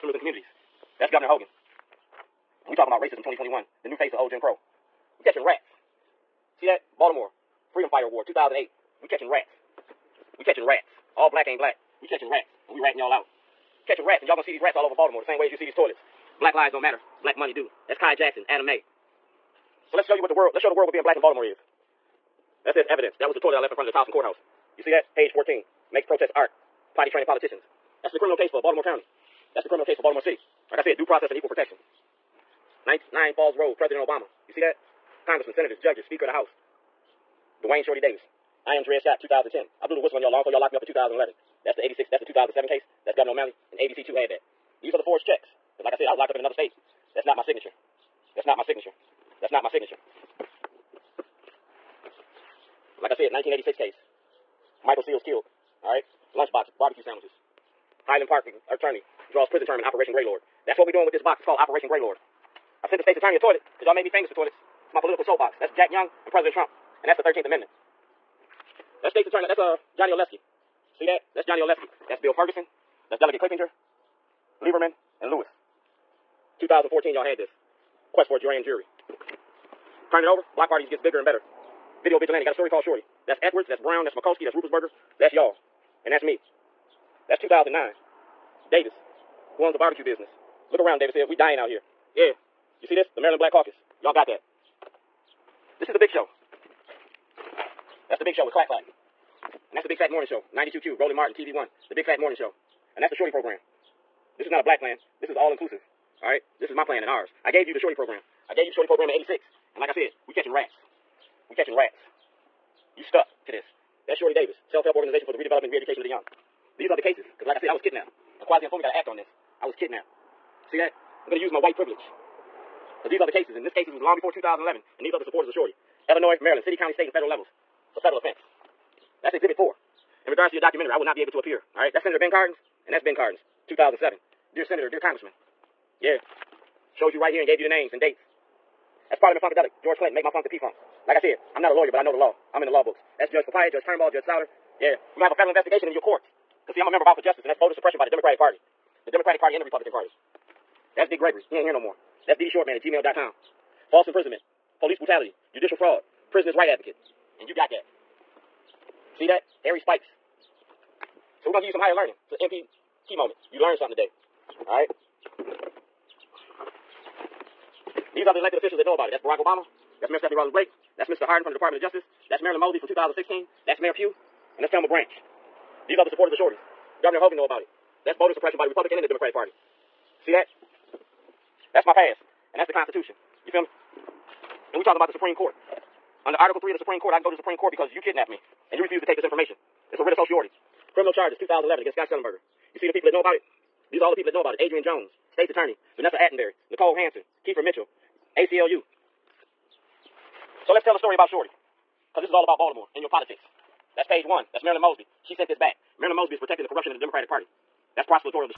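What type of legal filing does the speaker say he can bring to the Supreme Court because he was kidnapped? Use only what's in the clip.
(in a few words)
Writ of certiorari.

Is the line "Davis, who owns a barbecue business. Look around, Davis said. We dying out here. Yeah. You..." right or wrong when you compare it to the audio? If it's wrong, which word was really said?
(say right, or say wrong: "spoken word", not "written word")
right.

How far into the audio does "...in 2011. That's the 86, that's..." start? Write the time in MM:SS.
00:40.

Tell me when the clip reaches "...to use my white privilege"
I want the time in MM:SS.
02:01.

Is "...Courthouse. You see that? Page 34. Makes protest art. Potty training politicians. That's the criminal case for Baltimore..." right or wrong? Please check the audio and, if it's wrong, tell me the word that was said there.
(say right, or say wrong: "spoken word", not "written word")
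wrong: "14", not "34".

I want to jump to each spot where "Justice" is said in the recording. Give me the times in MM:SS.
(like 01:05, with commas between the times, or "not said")
02:27, 02:51.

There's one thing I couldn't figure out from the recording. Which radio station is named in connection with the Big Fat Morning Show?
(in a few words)
92Q.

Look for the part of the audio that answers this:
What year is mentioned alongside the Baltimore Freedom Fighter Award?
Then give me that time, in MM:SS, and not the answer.
00:08.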